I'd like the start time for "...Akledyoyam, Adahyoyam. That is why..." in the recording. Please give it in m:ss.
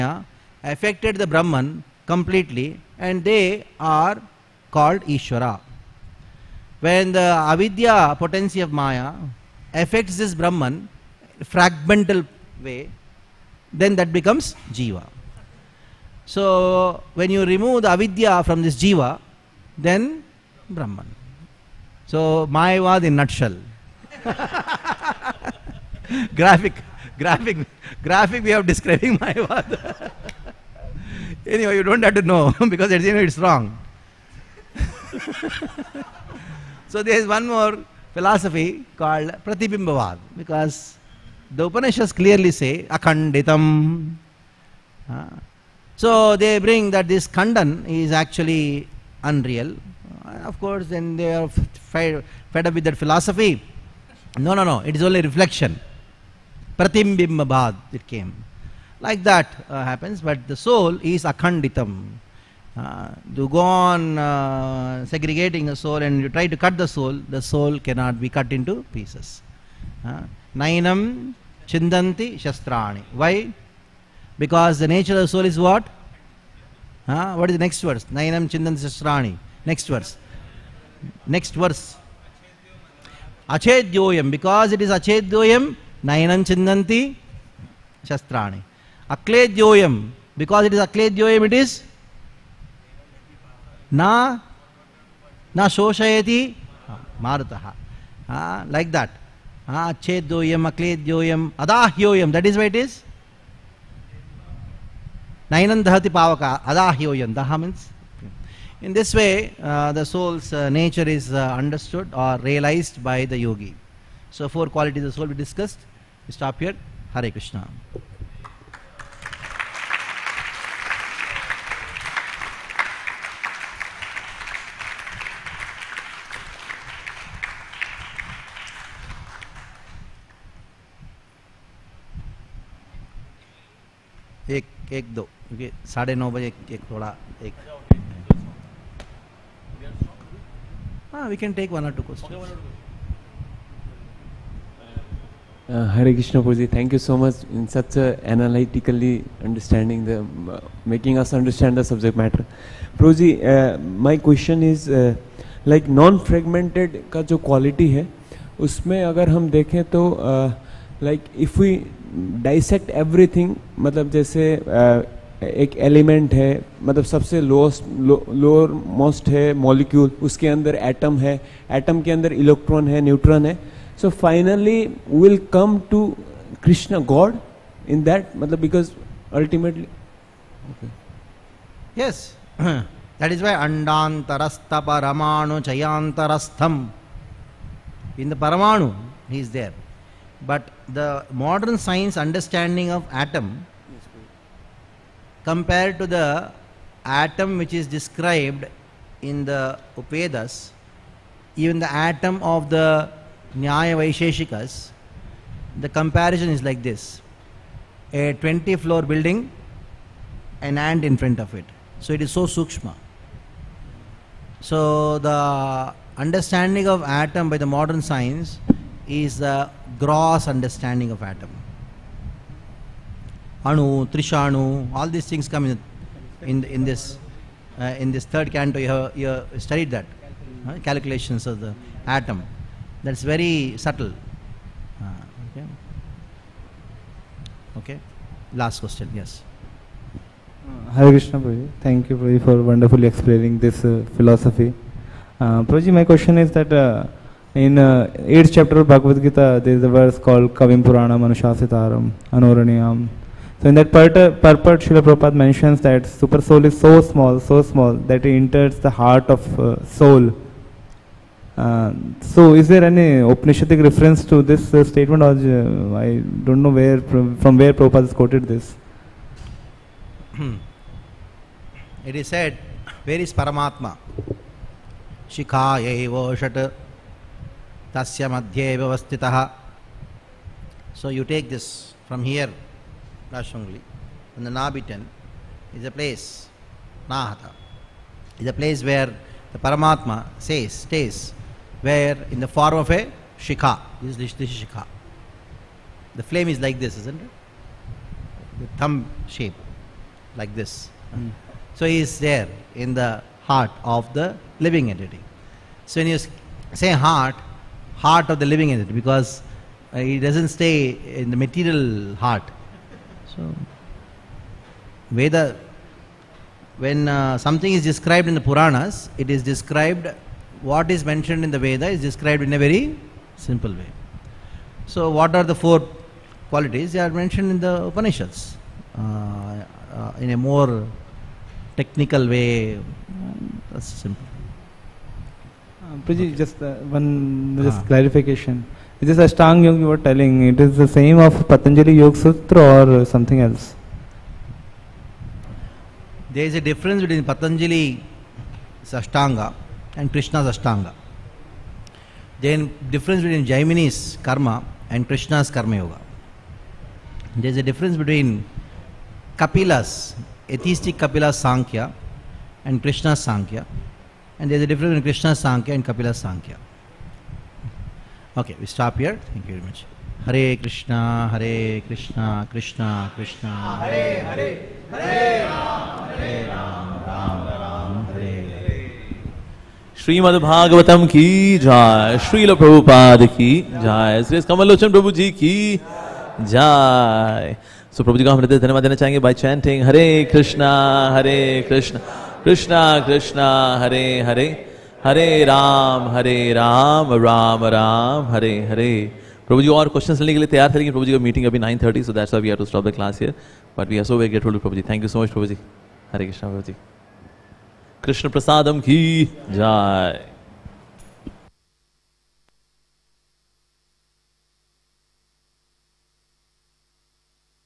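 1:40.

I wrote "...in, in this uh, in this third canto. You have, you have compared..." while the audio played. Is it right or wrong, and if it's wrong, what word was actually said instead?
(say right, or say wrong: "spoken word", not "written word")
wrong: "studied", not "compared".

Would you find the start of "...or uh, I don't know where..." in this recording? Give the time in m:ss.
4:25.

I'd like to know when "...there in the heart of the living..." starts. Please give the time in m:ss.
5:02.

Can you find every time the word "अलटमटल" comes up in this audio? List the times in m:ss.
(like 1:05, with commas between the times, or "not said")
2:59.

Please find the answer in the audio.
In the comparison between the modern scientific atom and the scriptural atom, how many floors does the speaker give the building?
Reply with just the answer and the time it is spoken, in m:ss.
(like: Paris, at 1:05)
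20, at 3:28.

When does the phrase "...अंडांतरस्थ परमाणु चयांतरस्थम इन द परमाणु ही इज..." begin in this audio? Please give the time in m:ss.
3:03.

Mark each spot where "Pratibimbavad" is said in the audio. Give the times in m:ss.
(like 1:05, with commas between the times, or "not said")
0:39, 0:56.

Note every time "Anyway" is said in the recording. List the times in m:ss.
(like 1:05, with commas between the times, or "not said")
0:31.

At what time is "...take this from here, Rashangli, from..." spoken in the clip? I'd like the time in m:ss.
4:41.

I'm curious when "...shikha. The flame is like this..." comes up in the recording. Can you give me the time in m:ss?
4:54.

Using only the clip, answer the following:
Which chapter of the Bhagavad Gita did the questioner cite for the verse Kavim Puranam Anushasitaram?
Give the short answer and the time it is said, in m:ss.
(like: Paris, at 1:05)
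8th chapter, at 4:08.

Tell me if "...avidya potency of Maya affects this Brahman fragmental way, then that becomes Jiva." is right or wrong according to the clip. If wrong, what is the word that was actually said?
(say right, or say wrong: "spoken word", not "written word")
right.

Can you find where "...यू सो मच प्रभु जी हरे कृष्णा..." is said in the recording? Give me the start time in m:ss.
6:45.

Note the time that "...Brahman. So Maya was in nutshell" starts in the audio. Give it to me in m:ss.
0:20.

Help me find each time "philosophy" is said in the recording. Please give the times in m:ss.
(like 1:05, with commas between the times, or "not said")
0:38, 0:52, 4:04.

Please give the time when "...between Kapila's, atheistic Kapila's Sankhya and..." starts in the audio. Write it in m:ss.
5:57.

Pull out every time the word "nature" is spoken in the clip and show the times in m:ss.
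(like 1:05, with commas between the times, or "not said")
1:14, 1:50.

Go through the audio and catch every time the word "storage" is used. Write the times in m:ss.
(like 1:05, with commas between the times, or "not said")
not said.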